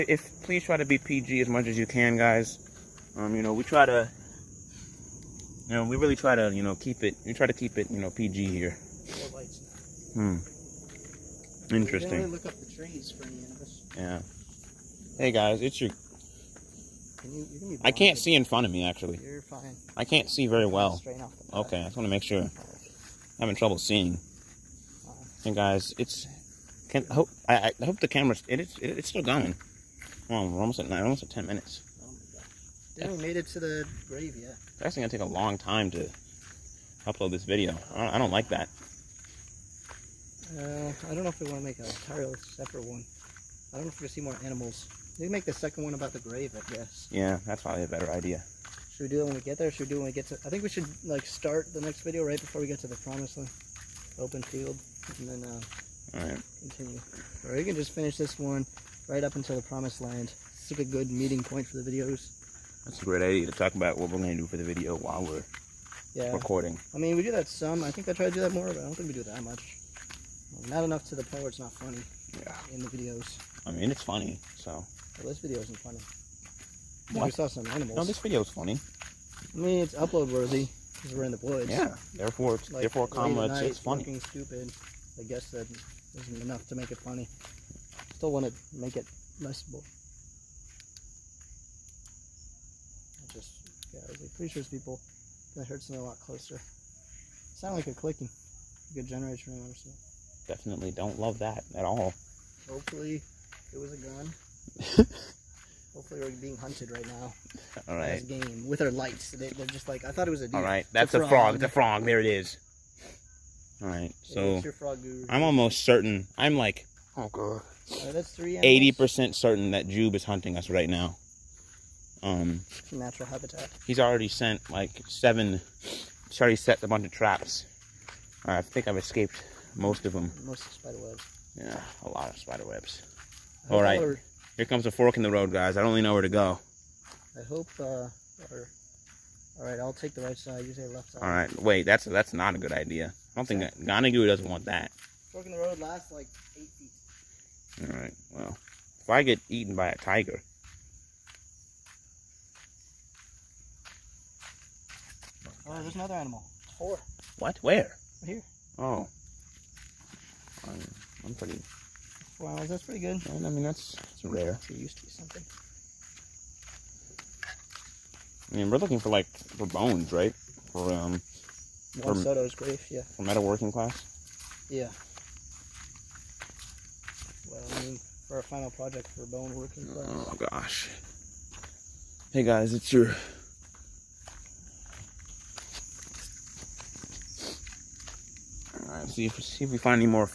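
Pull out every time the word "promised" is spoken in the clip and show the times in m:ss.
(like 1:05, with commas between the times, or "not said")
0:52, 0:59.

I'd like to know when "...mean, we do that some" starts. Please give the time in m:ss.
1:06.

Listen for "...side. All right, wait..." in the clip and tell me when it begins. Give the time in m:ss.
2:21.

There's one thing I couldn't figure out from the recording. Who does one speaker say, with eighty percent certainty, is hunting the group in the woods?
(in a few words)
Joob.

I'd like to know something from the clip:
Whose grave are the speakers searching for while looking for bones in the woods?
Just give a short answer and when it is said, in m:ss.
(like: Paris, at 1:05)
Soto, at 2:52.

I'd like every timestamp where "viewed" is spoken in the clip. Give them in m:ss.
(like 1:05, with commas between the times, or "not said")
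not said.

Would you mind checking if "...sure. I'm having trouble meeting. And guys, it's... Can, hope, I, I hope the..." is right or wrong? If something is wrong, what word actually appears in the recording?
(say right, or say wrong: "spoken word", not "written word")
wrong: "seeing", not "meeting".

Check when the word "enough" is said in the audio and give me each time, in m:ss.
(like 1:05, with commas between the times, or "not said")
1:10, 1:26.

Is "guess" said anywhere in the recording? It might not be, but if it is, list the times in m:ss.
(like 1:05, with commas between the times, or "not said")
0:46, 1:25.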